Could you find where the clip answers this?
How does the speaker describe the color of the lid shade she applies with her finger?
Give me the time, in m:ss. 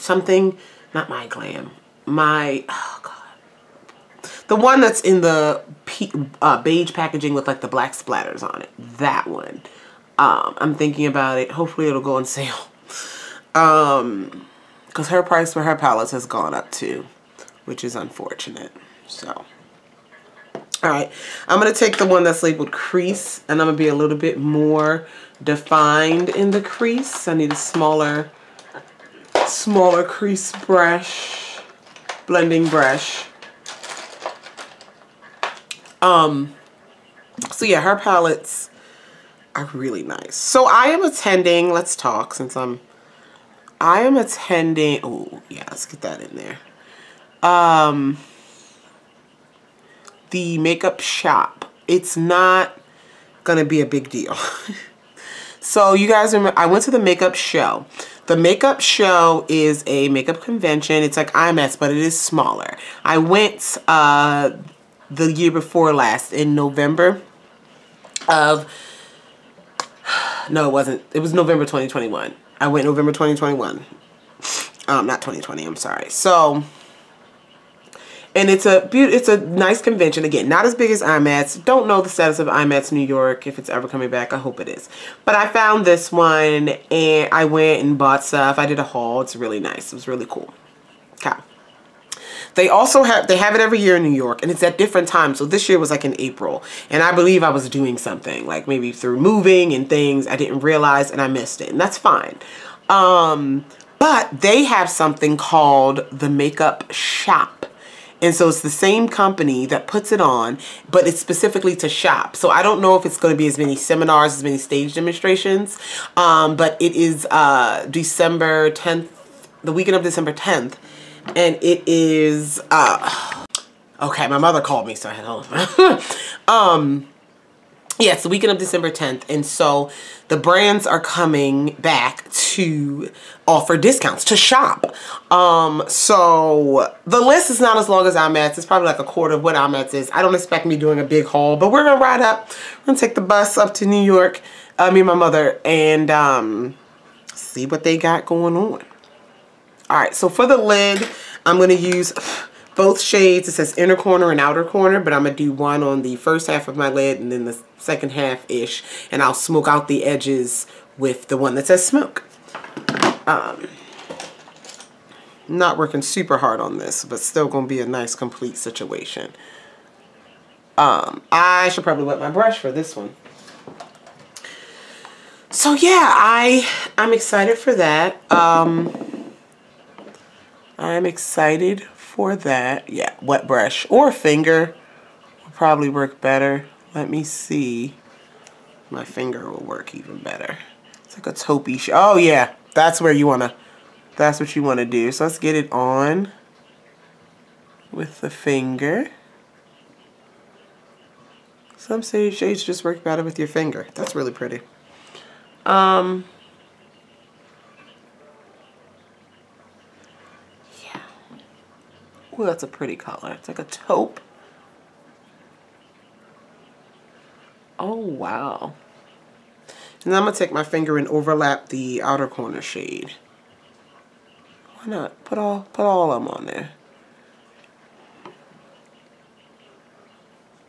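3:33.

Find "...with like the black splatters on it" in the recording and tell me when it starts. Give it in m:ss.
0:07.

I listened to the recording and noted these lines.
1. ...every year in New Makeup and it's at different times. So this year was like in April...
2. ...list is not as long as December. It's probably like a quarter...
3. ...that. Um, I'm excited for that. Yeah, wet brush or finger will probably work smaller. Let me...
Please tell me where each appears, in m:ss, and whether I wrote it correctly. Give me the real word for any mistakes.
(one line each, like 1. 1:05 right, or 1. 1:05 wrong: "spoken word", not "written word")
1. 1:33 wrong: "York", not "Makeup"
2. 2:17 wrong: "IMATS", not "December"
3. 2:57 wrong: "better", not "smaller".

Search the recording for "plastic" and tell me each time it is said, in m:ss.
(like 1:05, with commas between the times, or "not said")
not said.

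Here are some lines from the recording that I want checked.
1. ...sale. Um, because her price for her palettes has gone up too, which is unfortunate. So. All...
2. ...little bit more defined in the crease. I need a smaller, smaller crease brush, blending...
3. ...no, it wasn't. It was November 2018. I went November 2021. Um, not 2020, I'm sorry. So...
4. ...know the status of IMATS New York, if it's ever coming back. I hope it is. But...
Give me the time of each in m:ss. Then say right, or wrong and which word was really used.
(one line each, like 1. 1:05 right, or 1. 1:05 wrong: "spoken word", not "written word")
1. 0:12 right
2. 0:23 right
3. 1:10 wrong: "2021", not "2018"
4. 1:21 right.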